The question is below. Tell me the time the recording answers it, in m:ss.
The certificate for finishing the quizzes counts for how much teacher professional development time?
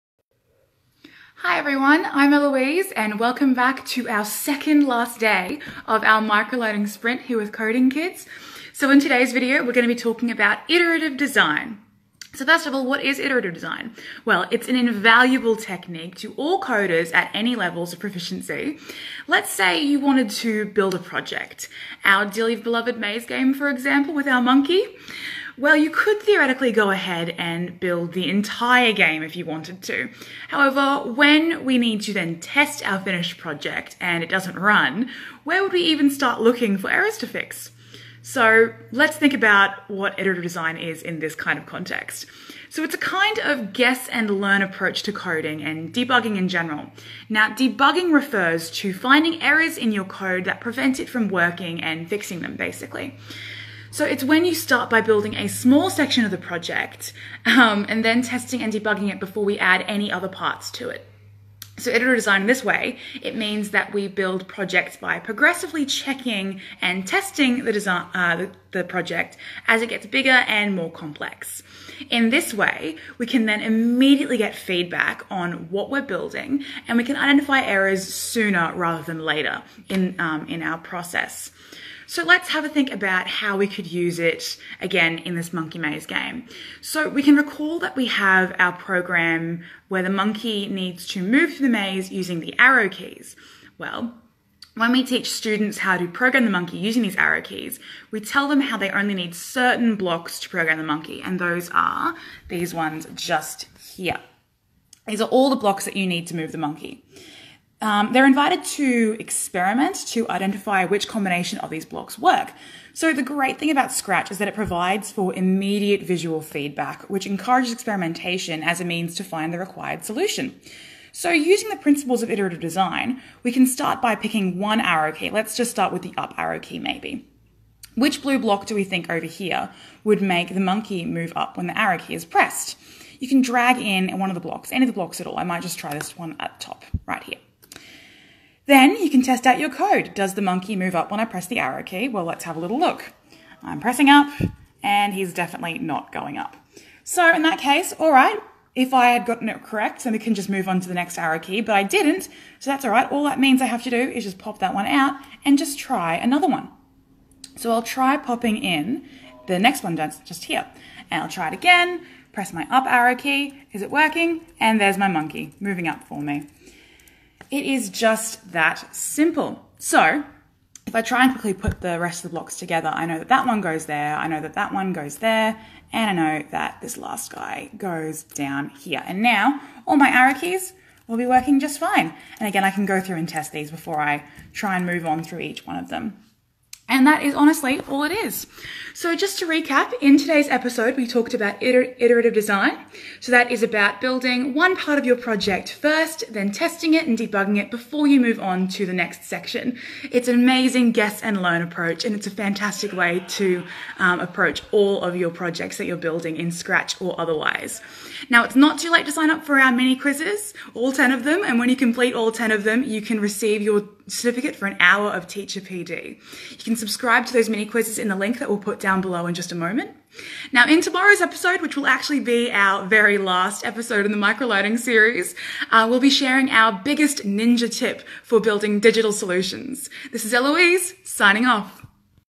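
3:34.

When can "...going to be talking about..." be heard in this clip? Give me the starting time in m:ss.
0:09.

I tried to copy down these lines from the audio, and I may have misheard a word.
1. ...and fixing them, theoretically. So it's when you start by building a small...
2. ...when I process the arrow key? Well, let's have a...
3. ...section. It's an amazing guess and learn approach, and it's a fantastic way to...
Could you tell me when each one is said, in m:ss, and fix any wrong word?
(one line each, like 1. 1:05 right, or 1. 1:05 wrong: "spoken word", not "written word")
1. 0:51 wrong: "basically", not "theoretically"
2. 2:21 wrong: "press", not "process"
3. 3:19 right.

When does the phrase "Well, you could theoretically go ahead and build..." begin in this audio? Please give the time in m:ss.
0:25.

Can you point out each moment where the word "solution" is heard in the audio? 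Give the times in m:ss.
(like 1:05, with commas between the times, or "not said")
2:00, 3:49.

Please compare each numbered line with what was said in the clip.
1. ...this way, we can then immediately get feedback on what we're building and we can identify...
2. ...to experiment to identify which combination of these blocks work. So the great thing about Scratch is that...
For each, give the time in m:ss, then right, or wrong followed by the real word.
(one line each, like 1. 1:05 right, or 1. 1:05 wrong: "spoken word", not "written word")
1. 1:12 right
2. 1:48 right.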